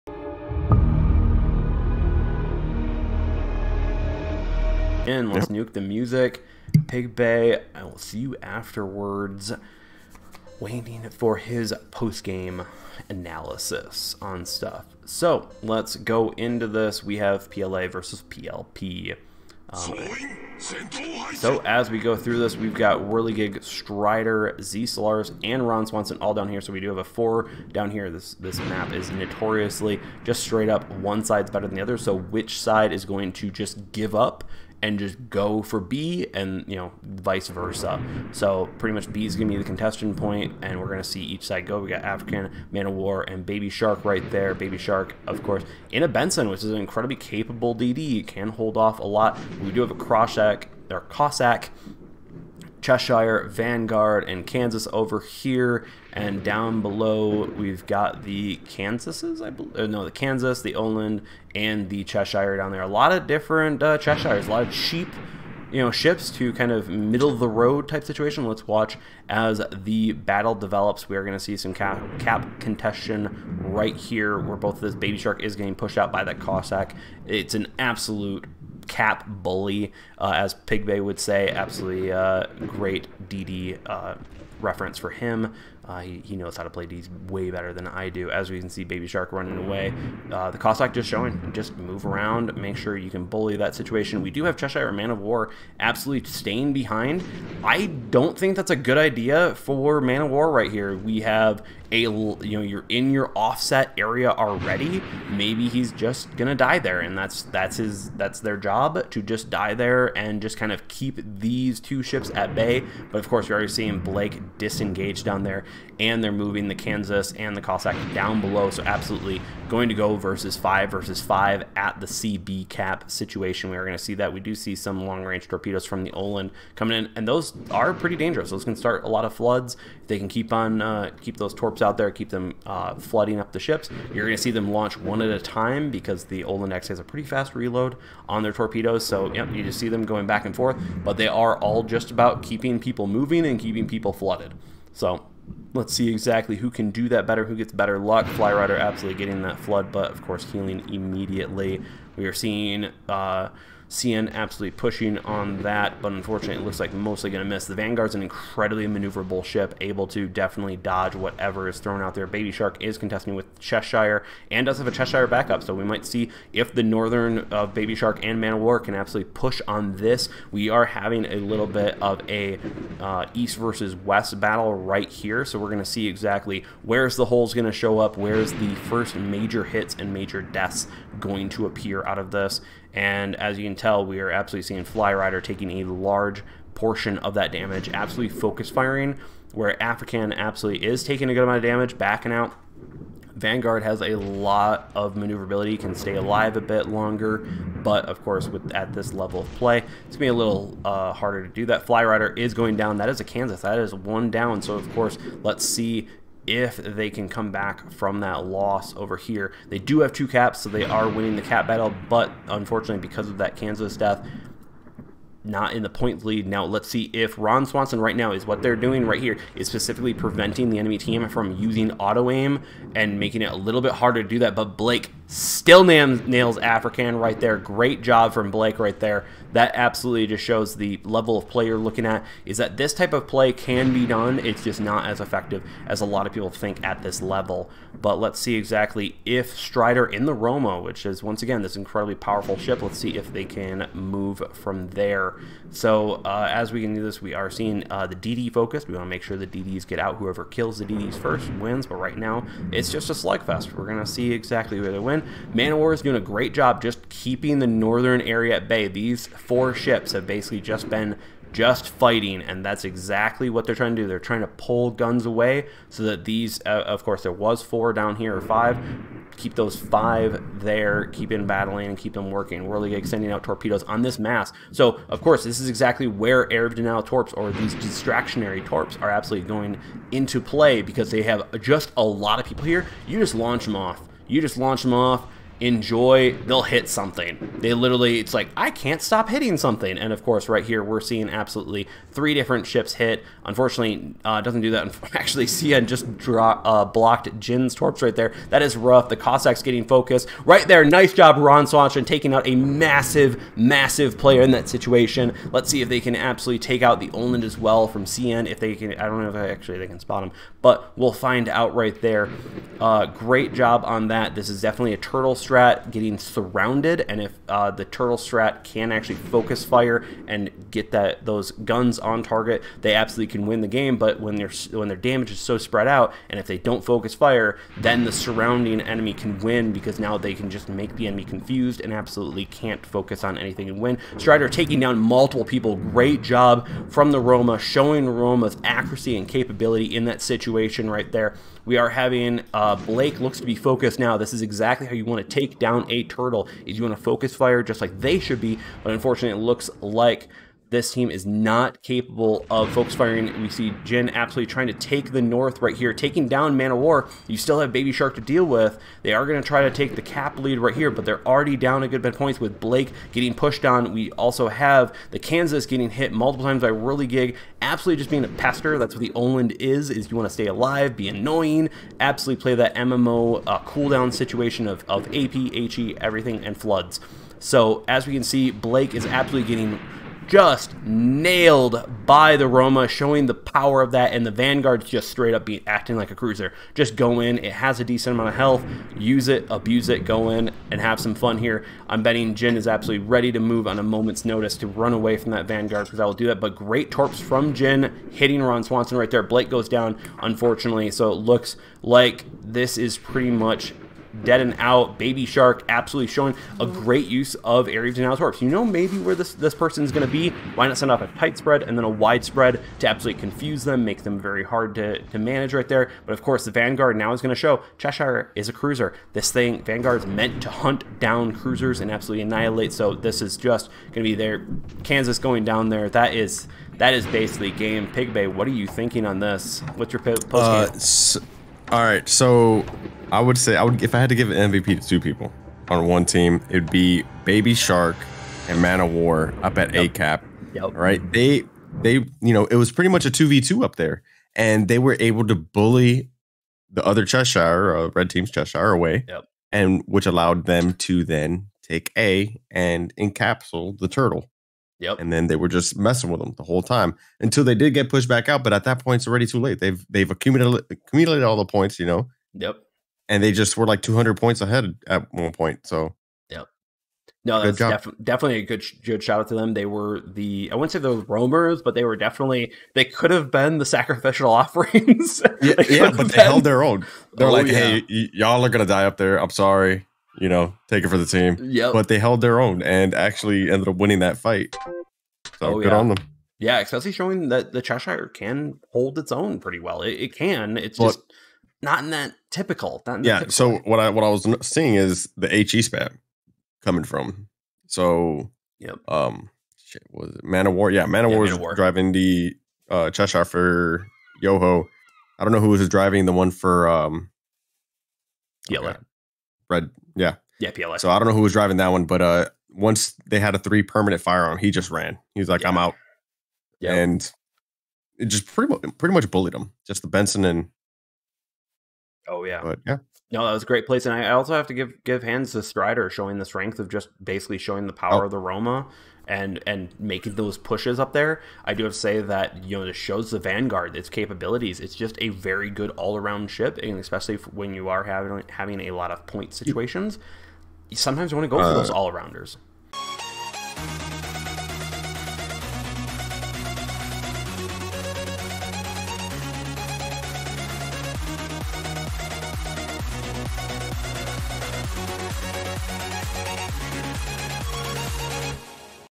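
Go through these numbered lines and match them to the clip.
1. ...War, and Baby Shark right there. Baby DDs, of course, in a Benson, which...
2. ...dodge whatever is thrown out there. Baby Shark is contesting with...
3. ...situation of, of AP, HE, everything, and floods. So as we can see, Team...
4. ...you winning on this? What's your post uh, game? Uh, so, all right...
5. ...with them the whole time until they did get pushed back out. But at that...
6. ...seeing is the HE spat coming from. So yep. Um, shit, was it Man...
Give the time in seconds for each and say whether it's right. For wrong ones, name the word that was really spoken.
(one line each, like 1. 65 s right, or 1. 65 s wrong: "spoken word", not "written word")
1. 42 s wrong: "Shark", not "DDs"
2. 160 s right
3. 374 s wrong: "Blake", not "Team"
4. 428 s wrong: "thinking", not "winning"
5. 456 s right
6. 494 s right.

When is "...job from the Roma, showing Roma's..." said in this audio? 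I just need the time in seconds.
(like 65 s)
336 s.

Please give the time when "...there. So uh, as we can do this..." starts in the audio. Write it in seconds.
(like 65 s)
244 s.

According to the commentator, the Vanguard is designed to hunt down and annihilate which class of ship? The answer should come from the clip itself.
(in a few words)
cruisers.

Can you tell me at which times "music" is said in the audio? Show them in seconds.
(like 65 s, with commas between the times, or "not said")
5 s.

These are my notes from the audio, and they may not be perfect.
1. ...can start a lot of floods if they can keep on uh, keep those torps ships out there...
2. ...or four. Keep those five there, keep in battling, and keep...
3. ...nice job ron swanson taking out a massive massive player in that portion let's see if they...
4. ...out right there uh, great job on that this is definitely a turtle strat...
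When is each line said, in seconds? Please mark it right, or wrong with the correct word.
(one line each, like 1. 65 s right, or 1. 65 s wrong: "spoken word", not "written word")
1. 128 s right
2. 268 s wrong: "five", not "four"
3. 300 s wrong: "situation", not "portion"
4. 311 s right.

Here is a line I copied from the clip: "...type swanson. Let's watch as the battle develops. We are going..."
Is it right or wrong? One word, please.
wrong.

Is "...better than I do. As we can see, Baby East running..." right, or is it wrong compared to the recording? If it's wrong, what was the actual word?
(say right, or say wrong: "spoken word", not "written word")
wrong: "Shark", not "East".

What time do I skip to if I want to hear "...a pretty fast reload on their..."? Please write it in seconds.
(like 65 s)
136 s.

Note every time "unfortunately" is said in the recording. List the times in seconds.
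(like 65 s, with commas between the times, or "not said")
156 s, 212 s, 293 s, 348 s, 400 s.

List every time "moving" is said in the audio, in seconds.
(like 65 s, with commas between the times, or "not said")
116 s, 143 s.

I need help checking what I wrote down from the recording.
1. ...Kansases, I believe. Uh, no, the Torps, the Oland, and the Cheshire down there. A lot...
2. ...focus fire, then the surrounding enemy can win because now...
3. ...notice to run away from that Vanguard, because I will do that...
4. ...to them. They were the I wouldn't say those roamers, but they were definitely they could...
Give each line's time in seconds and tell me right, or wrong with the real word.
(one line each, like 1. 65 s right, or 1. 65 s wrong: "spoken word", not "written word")
1. 58 s wrong: "Kansas", not "Torps"
2. 326 s right
3. 394 s right
4. 469 s right.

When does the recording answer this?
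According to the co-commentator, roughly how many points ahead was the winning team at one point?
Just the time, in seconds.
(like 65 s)
463 s.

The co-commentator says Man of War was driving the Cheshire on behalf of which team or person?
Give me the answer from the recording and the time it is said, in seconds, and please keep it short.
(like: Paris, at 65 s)
Yoho, at 504 s.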